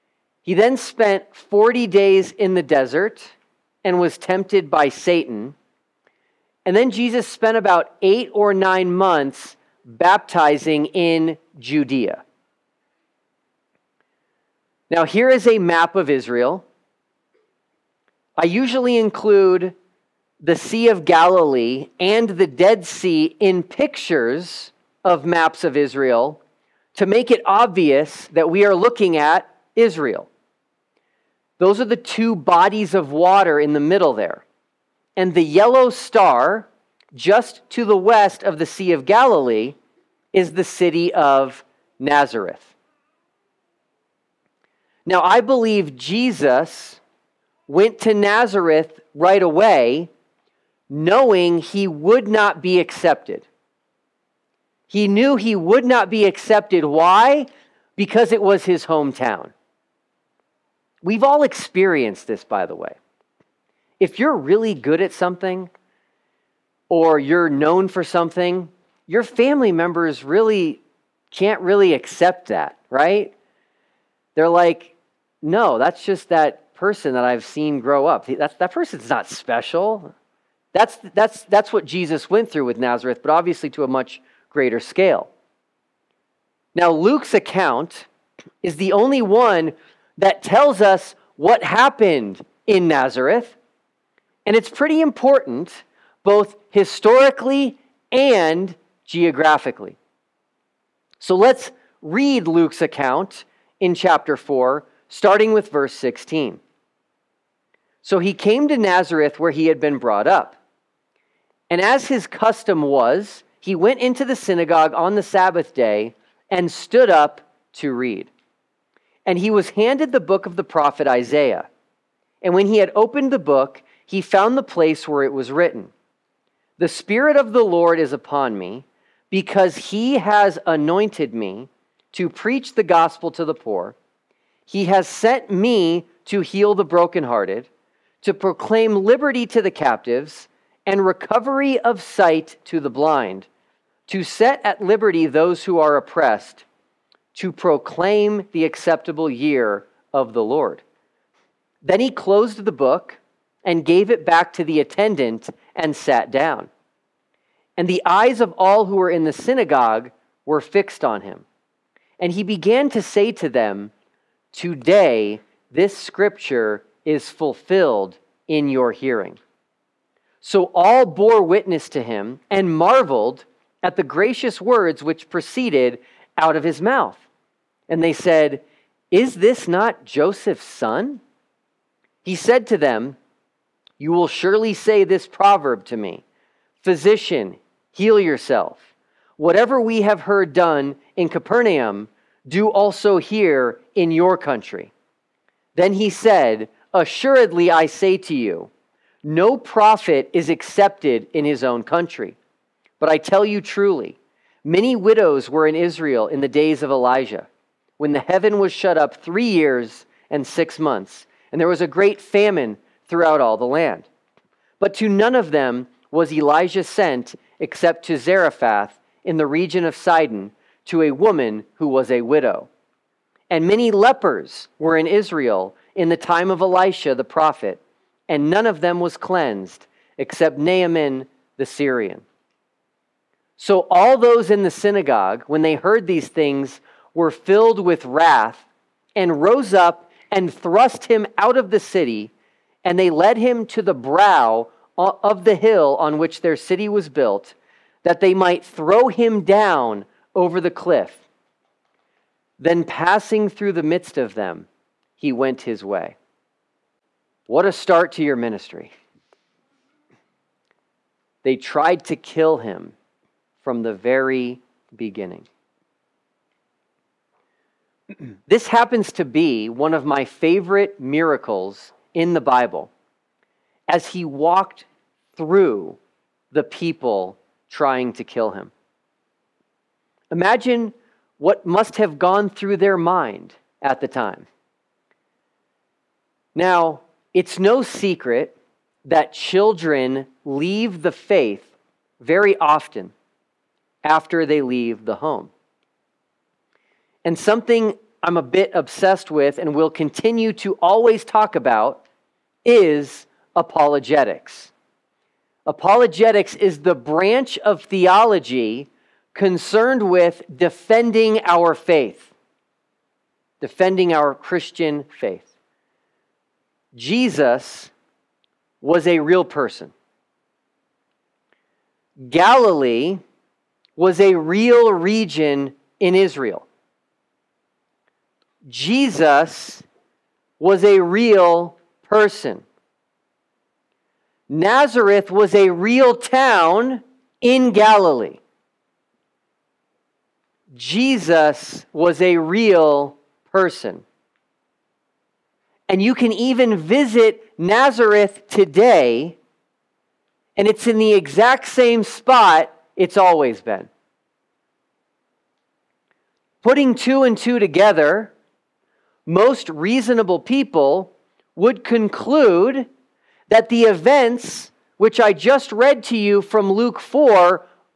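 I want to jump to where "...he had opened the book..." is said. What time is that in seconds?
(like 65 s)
122 s.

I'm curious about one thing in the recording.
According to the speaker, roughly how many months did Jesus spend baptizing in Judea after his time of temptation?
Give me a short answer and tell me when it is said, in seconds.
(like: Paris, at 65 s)
8 or 9 months, at 8 s.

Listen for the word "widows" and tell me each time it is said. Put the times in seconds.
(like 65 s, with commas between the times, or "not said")
204 s, 222 s.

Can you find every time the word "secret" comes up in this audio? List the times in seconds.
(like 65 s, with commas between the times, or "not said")
287 s.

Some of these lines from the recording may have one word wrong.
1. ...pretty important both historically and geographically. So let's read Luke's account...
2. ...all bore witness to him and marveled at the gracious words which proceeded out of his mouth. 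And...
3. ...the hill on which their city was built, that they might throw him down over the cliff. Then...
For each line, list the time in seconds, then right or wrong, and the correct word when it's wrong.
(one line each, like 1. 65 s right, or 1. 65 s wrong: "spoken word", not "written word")
1. 94 s right
2. 170 s right
3. 245 s right.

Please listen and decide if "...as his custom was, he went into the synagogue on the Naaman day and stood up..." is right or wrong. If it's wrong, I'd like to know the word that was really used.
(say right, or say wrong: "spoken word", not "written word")
wrong: "Sabbath", not "Naaman".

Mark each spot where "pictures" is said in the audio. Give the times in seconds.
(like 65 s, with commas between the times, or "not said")
23 s.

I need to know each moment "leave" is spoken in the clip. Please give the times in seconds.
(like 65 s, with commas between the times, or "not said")
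290 s, 294 s.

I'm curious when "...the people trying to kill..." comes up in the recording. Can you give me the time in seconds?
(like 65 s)
276 s.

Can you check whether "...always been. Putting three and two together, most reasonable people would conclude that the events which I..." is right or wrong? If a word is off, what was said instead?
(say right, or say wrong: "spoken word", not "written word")
wrong: "two", not "three".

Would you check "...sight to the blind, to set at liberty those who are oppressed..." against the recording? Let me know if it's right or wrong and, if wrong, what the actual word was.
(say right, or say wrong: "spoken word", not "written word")
right.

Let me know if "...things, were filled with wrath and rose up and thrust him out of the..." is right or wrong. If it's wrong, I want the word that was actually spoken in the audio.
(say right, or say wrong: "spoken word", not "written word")
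right.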